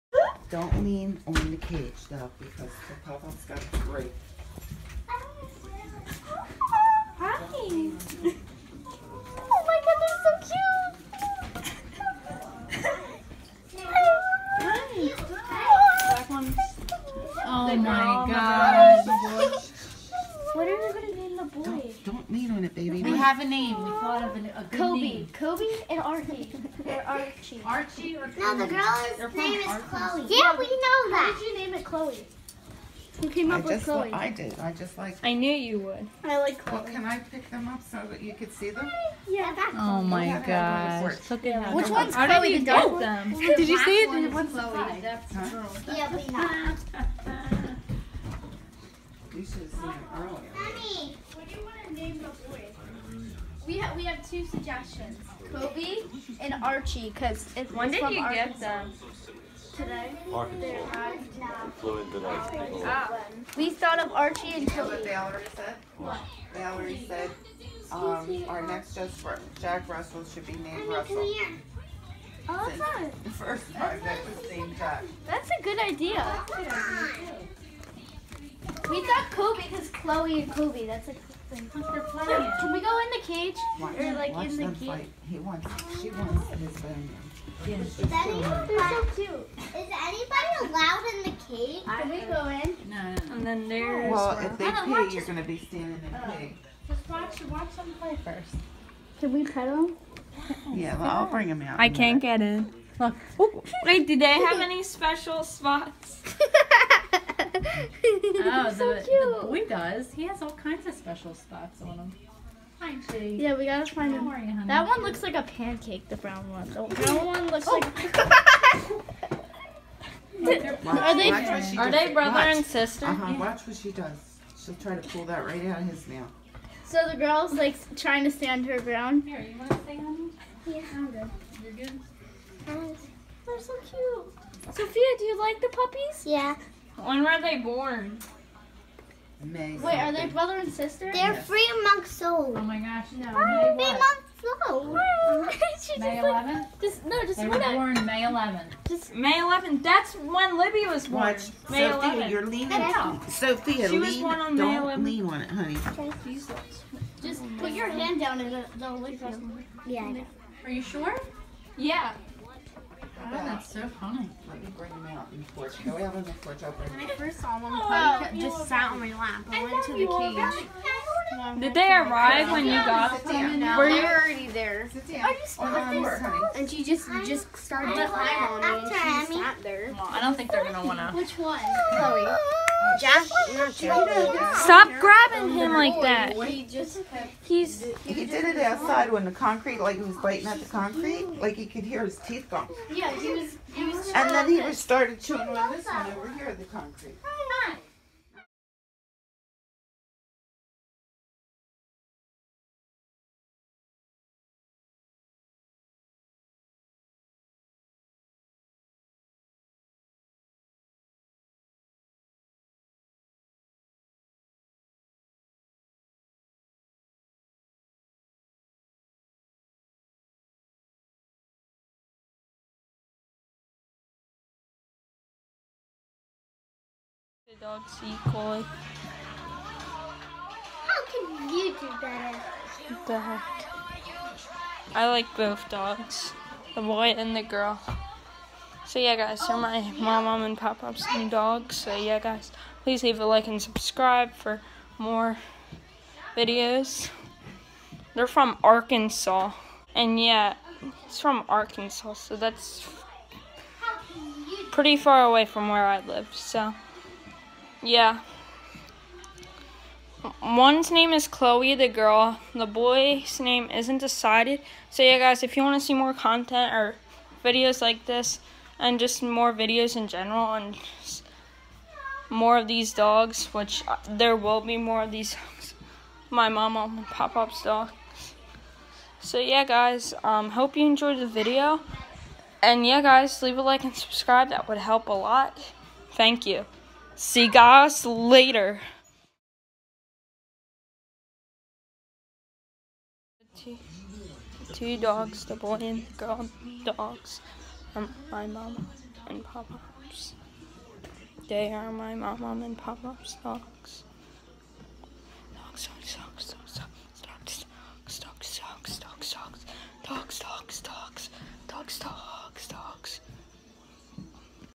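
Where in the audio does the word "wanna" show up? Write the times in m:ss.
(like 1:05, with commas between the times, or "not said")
3:00.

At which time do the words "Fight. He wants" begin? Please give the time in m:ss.
1:24.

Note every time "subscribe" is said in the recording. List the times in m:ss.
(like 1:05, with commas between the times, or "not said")
4:03, 4:43.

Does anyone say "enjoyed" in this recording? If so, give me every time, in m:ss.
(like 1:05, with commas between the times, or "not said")
4:40.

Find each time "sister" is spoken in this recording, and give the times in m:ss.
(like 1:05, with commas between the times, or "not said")
2:02, 2:20.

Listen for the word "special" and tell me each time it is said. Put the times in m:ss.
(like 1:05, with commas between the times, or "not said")
1:44, 1:50.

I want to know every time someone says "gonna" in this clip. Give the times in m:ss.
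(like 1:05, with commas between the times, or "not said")
0:20, 1:35, 3:00.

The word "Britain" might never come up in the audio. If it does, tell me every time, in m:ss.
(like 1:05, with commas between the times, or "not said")
not said.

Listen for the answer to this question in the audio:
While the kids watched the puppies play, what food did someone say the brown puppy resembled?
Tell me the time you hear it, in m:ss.
1:55.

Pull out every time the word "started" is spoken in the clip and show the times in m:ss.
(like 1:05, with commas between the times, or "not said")
2:57, 3:14.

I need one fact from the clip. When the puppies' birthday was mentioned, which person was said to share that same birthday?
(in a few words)
Libby.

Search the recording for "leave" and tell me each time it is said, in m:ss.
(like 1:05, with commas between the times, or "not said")
4:03, 4:43.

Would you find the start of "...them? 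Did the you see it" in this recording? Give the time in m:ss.
0:42.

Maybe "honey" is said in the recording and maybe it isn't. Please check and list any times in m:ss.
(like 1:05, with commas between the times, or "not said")
1:54, 2:35.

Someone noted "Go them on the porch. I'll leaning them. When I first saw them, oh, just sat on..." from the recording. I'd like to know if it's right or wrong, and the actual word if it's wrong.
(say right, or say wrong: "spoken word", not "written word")
wrong: "bring", not "leaning".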